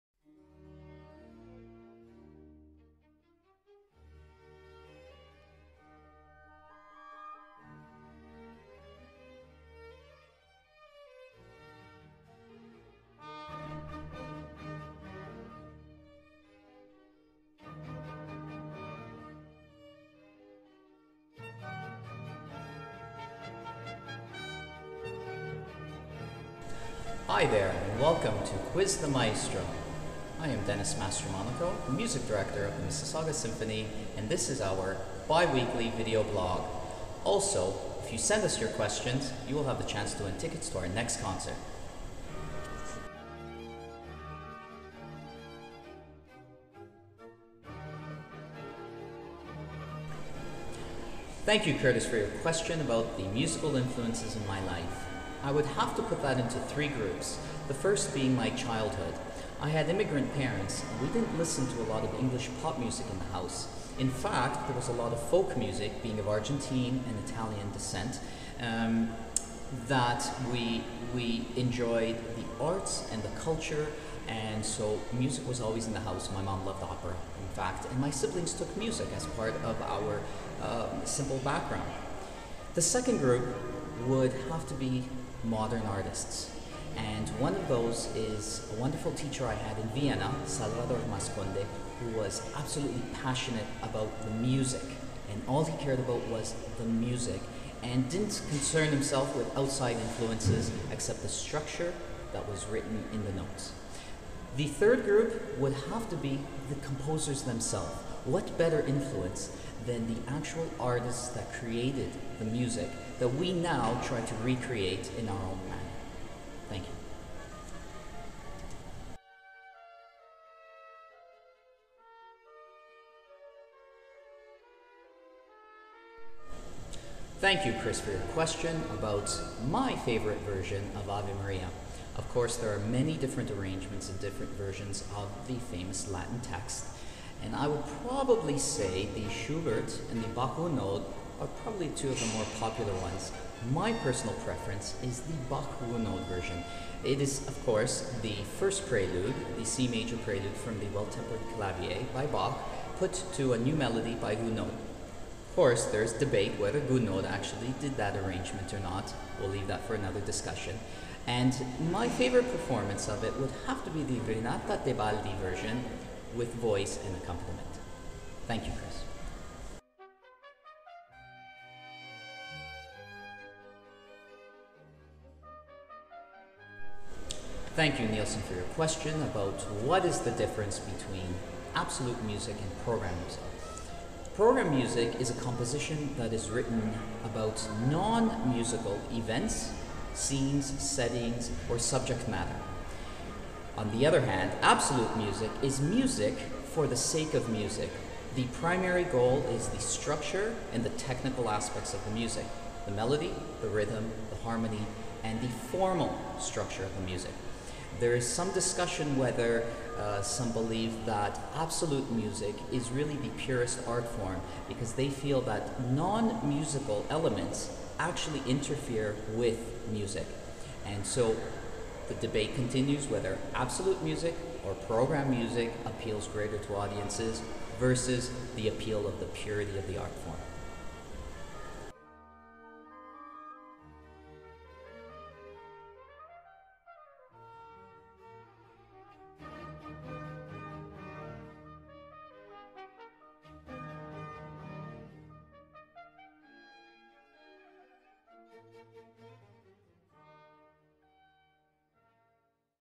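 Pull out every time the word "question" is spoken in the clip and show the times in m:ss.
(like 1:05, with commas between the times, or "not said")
0:38, 0:52, 2:08, 2:58.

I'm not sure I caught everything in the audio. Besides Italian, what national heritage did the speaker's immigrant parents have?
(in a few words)
Argentine.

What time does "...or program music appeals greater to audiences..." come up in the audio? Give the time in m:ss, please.
3:44.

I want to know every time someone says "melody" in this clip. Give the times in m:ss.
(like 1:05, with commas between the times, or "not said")
2:33, 3:22.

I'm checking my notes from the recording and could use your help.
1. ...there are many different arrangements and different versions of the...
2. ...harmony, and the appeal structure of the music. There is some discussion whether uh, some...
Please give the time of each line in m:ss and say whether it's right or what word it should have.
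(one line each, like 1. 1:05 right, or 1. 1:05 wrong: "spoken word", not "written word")
1. 2:12 right
2. 3:24 wrong: "formal", not "appeal".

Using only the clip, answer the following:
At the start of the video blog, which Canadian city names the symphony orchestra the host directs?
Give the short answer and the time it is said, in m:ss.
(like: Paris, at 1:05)
Mississauga, at 0:32.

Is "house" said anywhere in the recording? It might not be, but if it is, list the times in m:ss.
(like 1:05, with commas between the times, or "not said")
1:03, 1:16.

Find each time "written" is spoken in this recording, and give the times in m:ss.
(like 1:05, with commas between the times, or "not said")
1:42, 3:06.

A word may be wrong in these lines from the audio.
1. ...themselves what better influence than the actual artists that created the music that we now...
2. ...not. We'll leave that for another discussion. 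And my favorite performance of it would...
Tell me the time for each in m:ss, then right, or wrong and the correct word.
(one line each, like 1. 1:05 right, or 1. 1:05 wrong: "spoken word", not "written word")
1. 1:47 right
2. 2:38 right.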